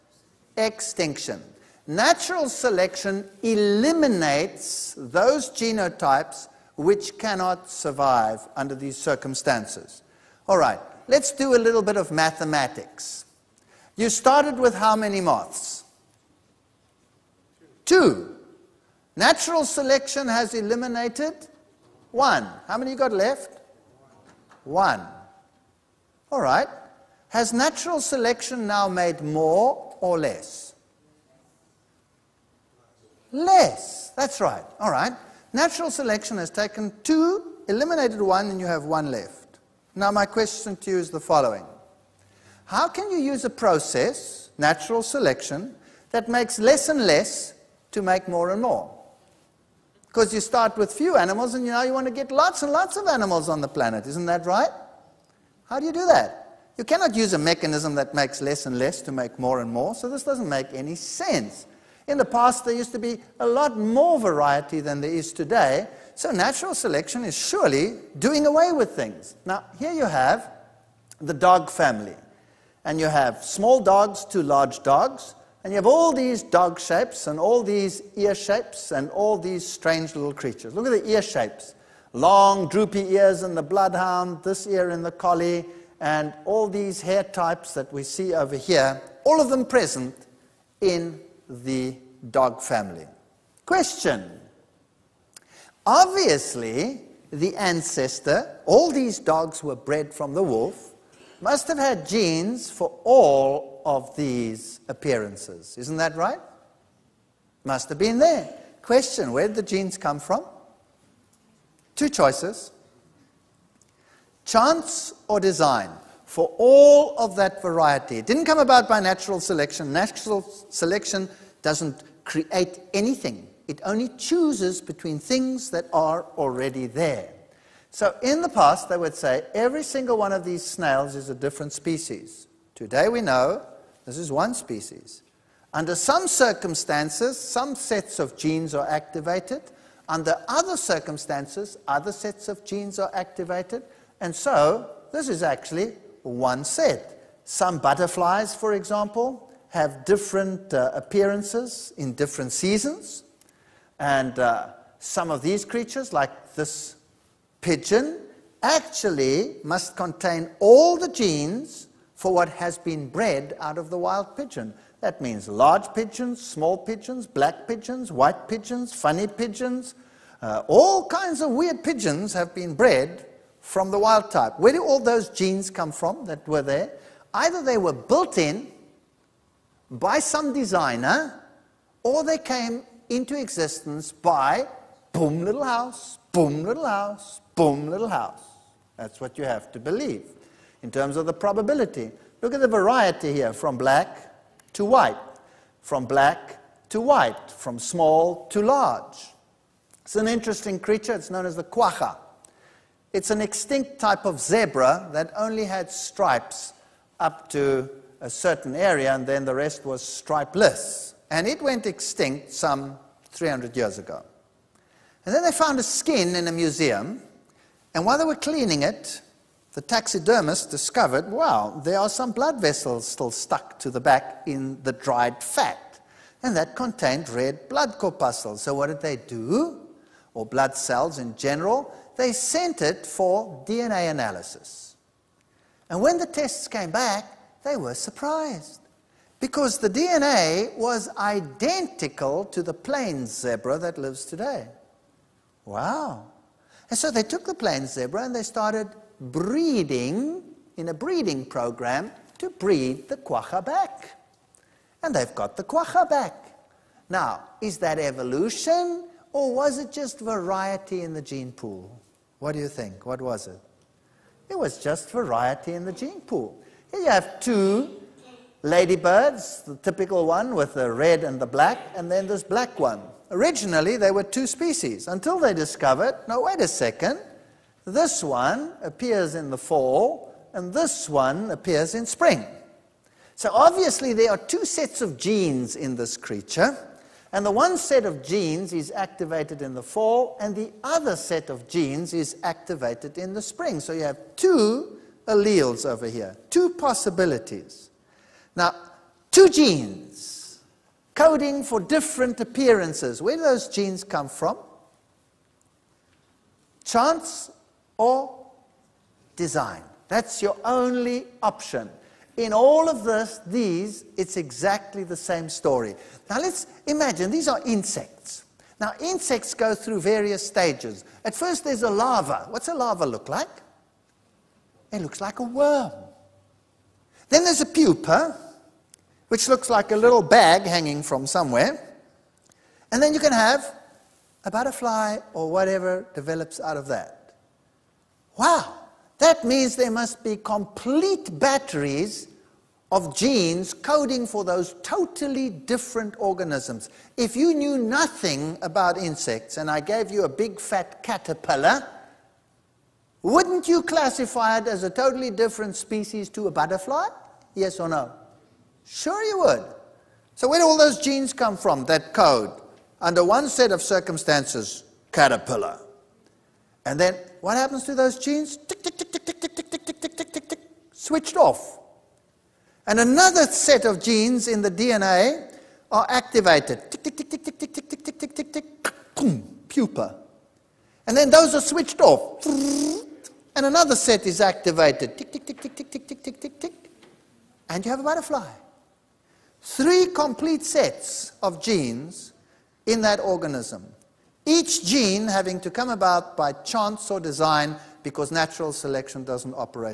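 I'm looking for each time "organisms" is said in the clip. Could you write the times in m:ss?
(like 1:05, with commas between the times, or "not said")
5:46, 6:33.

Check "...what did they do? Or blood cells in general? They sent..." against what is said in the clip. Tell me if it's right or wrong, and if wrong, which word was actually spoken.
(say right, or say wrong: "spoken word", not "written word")
right.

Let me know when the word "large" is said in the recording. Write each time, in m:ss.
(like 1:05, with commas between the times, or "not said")
1:14, 2:45, 3:18.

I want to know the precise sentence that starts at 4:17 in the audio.
Now, is that evolution or was it just variety in the gene pool?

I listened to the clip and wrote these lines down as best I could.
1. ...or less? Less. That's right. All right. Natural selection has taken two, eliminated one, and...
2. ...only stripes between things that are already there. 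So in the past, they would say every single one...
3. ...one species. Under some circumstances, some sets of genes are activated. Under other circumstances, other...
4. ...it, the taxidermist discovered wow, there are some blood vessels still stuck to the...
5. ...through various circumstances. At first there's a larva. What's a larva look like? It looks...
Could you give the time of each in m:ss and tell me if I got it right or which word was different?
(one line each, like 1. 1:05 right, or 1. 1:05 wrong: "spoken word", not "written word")
1. 0:30 right
2. 2:03 wrong: "chooses", not "stripes"
3. 2:14 right
4. 3:38 right
5. 5:19 wrong: "stages", not "circumstances".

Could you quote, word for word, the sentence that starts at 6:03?
Under one set of circumstances, caterpillar.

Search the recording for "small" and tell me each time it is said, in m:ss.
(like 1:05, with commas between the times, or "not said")
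1:13, 2:46, 3:17.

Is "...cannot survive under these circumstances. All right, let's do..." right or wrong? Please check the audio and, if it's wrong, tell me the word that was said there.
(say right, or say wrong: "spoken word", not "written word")
right.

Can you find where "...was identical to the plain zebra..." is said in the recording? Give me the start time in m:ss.
4:00.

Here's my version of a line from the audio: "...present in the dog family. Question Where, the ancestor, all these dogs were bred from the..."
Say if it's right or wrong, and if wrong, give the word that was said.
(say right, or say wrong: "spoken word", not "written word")
wrong: "Obviously", not "Where".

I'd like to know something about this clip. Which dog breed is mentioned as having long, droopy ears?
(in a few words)
Bloodhound.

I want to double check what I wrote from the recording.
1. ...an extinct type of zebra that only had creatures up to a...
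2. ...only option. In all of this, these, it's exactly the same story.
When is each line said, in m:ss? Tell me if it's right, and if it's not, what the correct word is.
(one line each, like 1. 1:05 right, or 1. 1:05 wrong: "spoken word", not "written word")
1. 3:23 wrong: "stripes", not "creatures"
2. 5:10 right.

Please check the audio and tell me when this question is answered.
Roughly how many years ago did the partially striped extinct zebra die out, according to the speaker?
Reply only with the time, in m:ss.
3:33.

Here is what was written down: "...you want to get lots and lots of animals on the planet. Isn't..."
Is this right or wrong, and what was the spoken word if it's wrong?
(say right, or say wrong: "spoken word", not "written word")
right.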